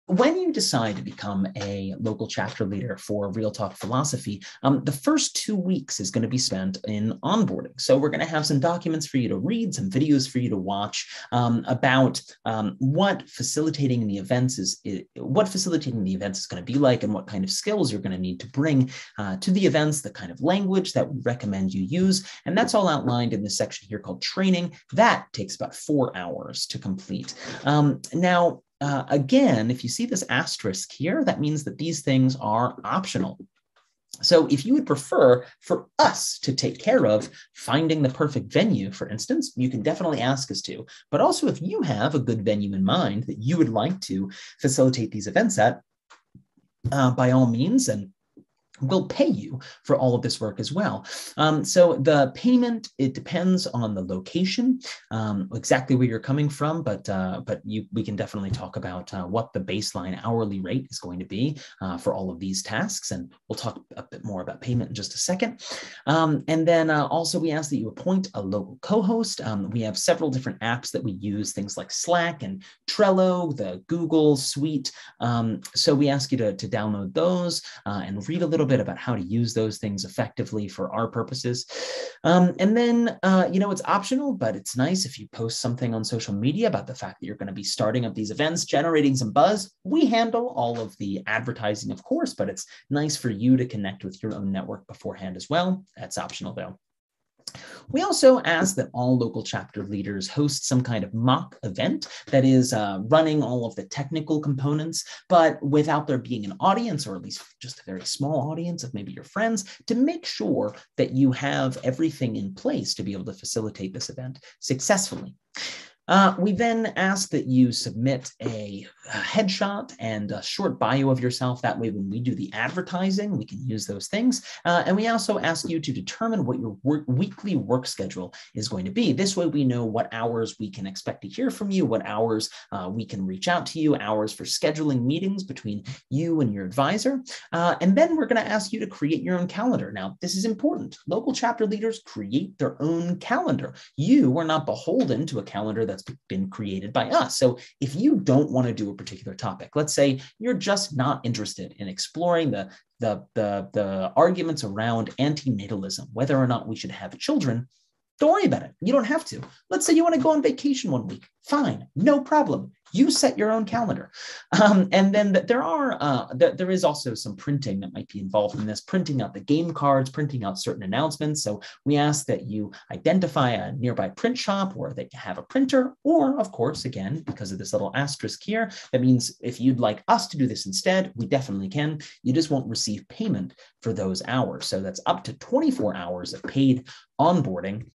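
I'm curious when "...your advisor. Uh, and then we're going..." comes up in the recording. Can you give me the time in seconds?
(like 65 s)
136 s.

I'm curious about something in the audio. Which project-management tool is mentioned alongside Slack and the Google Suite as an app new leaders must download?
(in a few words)
Trello.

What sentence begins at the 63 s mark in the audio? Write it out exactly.
And we'll talk a bit more about payment in just a second.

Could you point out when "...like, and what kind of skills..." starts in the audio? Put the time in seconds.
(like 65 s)
16 s.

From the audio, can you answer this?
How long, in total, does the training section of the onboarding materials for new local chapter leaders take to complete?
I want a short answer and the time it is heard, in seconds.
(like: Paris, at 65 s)
4 hours, at 25 s.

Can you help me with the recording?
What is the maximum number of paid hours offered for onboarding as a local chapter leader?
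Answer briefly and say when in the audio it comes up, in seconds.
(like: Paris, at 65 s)
24, at 185 s.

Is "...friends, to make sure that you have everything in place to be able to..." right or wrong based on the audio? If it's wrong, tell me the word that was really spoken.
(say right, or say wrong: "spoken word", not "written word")
right.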